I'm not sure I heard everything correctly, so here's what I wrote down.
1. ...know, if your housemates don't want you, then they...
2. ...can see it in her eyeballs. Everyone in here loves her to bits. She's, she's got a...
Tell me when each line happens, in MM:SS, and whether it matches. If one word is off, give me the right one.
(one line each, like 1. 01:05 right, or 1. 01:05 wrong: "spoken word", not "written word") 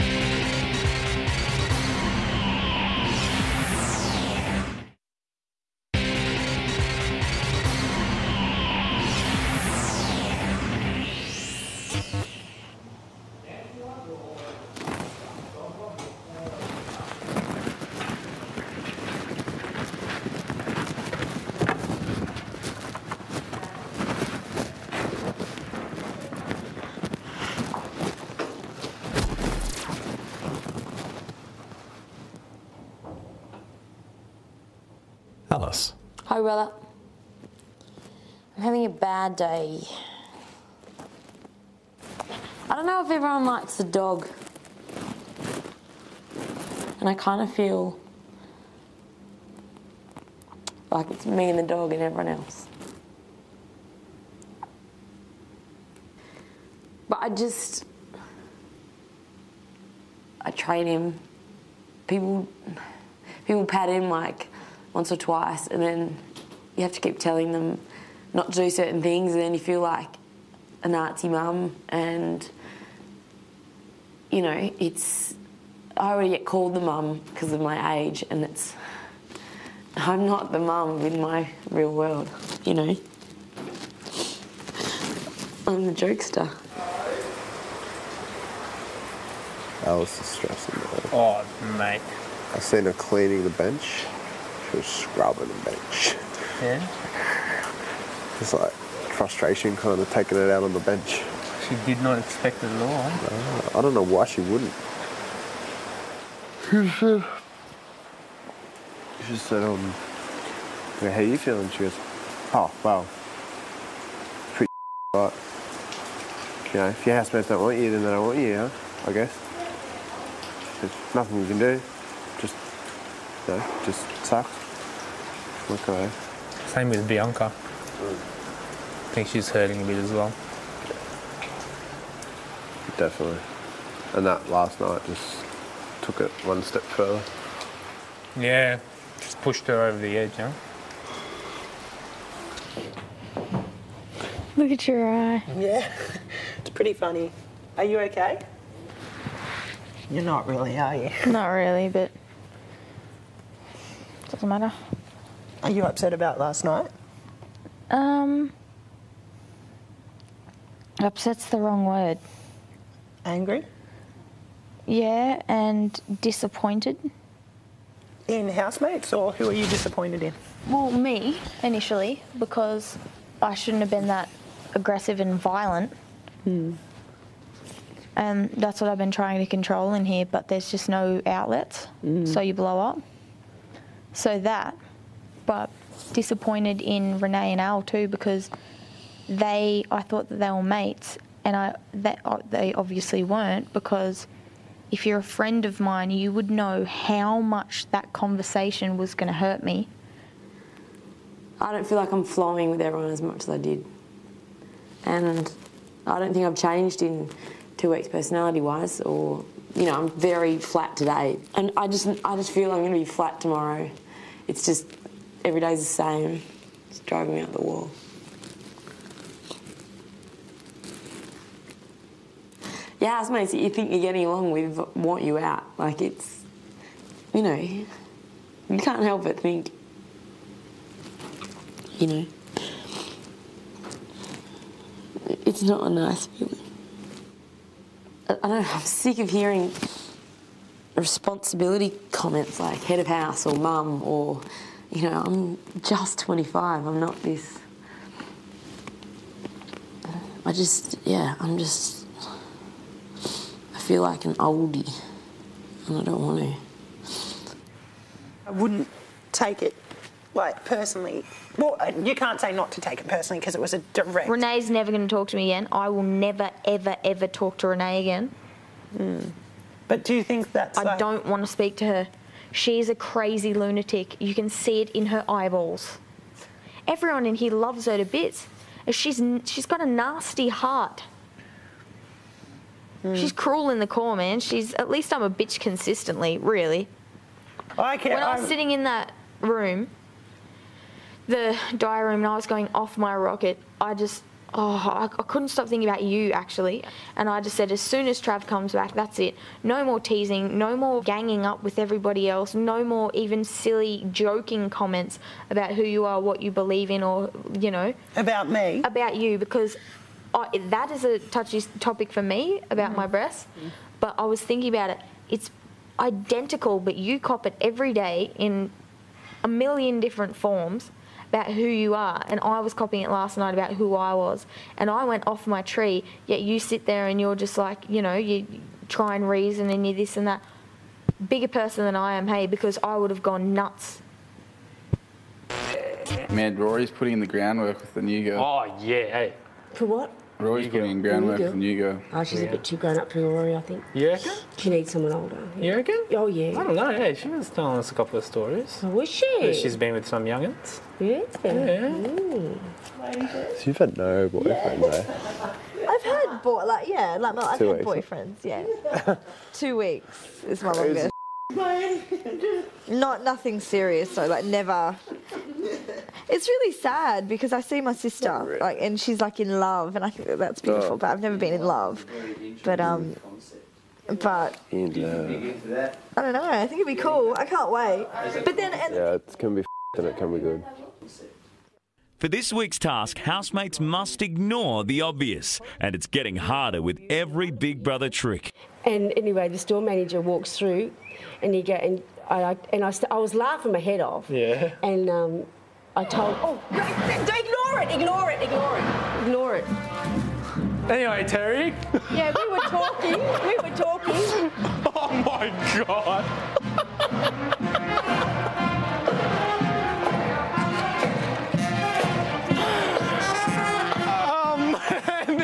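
1. 01:56 right
2. 04:34 right.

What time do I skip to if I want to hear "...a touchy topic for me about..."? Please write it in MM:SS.
05:11.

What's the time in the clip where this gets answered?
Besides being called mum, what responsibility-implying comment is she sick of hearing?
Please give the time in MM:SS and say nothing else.
04:02.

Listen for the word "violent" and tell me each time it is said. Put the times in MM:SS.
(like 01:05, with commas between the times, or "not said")
02:55.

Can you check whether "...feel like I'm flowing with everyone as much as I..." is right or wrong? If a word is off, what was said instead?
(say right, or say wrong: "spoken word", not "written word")
right.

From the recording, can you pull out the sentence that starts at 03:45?
Like it's, you know, you can't help but think, you know, it's not a nice feeling.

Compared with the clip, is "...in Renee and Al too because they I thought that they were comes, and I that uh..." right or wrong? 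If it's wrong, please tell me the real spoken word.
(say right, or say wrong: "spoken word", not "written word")
wrong: "mates", not "comes".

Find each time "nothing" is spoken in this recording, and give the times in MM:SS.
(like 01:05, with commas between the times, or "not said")
02:01, 06:03.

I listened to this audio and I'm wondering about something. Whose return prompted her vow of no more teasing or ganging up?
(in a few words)
Trav.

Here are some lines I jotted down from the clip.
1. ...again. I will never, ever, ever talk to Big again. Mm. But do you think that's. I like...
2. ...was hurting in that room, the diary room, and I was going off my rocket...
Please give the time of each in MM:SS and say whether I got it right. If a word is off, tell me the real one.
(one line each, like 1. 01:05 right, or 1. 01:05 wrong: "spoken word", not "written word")
1. 04:25 wrong: "Renee", not "Big"
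2. 04:48 wrong: "sitting", not "hurting".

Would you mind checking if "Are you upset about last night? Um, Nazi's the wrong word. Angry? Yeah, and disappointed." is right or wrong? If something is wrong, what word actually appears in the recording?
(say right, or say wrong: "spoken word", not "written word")
wrong: "Upset", not "Nazi".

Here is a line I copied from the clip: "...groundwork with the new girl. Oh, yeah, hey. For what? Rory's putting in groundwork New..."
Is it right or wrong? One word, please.
right.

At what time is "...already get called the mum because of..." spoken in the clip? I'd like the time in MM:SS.
01:16.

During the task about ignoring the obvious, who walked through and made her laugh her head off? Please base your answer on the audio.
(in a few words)
The store manager.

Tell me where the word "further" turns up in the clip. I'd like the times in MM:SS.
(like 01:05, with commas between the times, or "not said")
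02:16.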